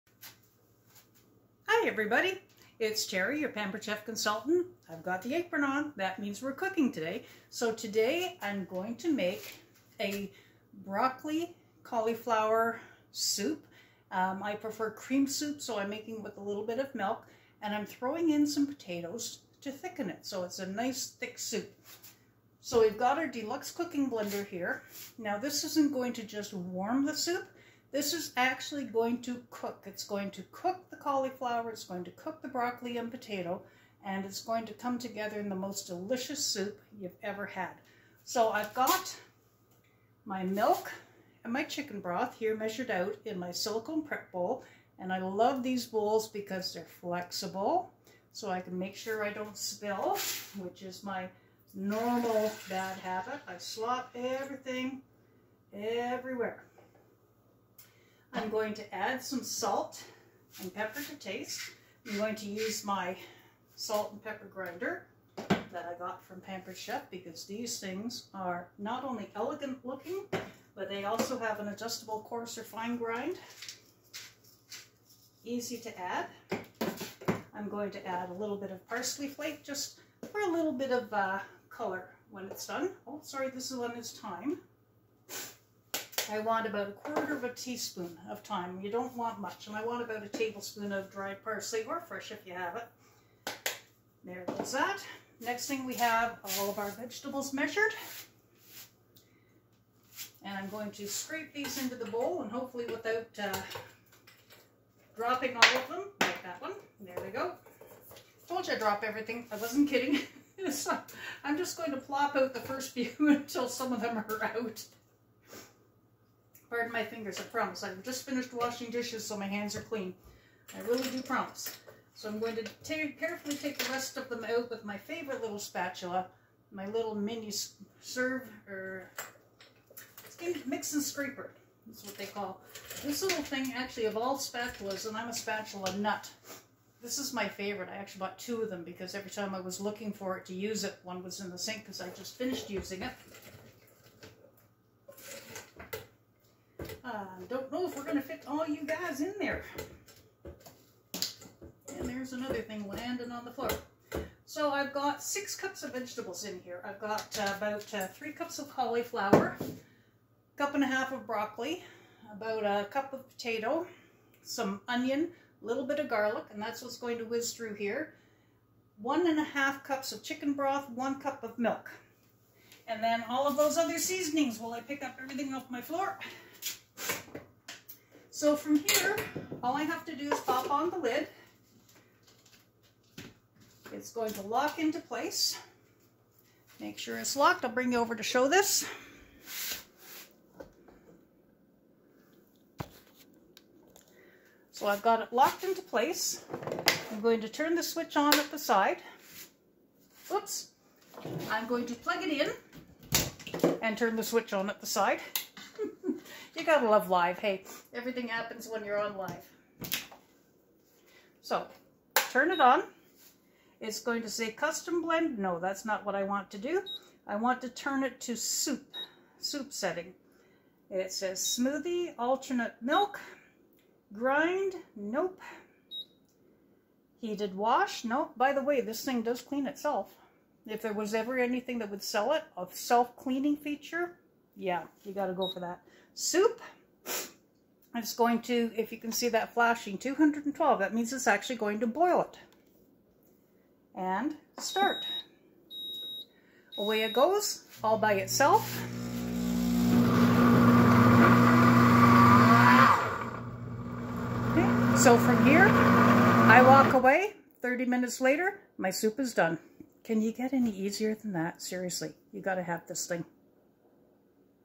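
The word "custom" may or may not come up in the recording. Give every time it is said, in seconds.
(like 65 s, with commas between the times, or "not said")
214 s.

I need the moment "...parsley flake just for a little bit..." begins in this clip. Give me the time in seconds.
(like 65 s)
78 s.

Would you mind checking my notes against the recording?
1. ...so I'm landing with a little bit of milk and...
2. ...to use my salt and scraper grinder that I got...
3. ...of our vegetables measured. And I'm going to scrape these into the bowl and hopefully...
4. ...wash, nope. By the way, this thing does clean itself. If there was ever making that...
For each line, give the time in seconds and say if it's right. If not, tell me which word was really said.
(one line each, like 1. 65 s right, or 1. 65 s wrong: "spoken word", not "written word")
1. 15 s wrong: "making", not "landing"
2. 62 s wrong: "pepper", not "scraper"
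3. 96 s right
4. 227 s wrong: "anything", not "making".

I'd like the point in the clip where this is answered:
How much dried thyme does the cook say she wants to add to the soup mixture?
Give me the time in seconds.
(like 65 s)
86 s.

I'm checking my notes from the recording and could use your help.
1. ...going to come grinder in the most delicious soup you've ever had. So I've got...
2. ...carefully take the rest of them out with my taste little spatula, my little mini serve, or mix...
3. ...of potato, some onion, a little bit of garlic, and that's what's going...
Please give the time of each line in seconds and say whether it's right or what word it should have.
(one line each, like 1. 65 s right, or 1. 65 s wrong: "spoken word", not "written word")
1. 34 s wrong: "together", not "grinder"
2. 123 s wrong: "favorite", not "taste"
3. 163 s right.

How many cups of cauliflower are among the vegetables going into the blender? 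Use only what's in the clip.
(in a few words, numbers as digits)
3 cups.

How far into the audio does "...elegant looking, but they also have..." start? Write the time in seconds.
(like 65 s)
69 s.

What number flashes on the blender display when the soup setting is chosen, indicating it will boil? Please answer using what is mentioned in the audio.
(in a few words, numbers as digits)
212.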